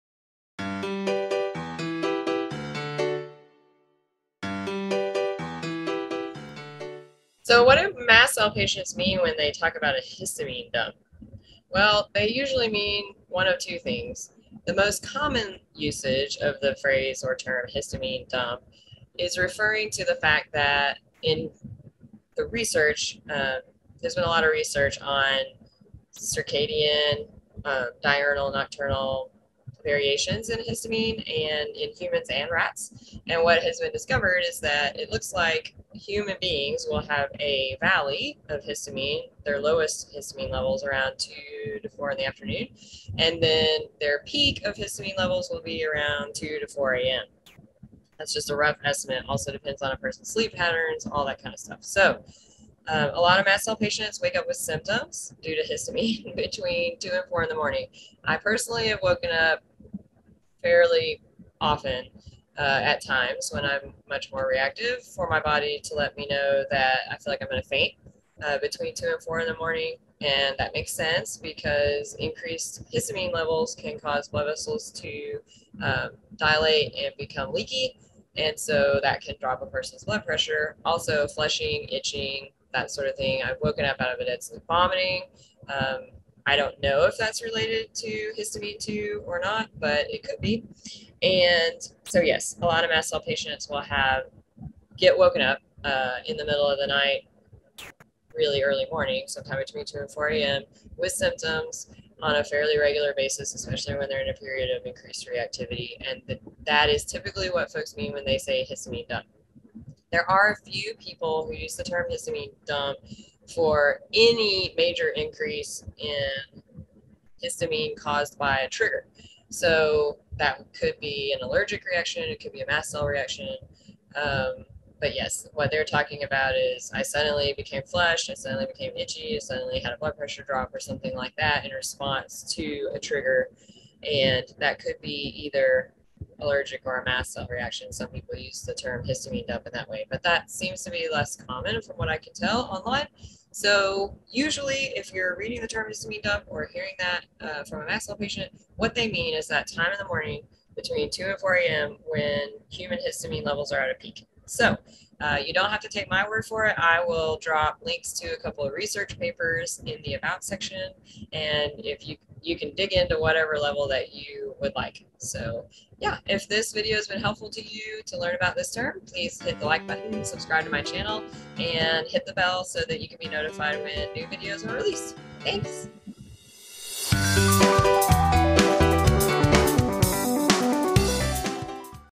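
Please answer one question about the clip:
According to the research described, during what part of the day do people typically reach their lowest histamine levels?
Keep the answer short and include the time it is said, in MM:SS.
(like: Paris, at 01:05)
2 to 4 in the afternoon, at 00:41.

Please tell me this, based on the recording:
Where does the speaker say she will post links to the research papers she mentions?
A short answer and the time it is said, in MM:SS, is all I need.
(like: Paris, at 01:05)
About section, at 02:40.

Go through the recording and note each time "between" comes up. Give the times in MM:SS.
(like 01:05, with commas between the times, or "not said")
00:56, 01:08, 01:39, 02:30.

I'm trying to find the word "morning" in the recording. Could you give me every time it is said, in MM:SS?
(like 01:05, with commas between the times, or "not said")
00:57, 01:09, 01:38, 02:30.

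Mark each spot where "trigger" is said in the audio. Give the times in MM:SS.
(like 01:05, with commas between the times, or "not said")
01:58, 02:12.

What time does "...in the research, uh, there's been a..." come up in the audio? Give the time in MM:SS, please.
00:21.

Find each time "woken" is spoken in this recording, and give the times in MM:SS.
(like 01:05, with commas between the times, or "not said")
00:59, 01:23, 01:35.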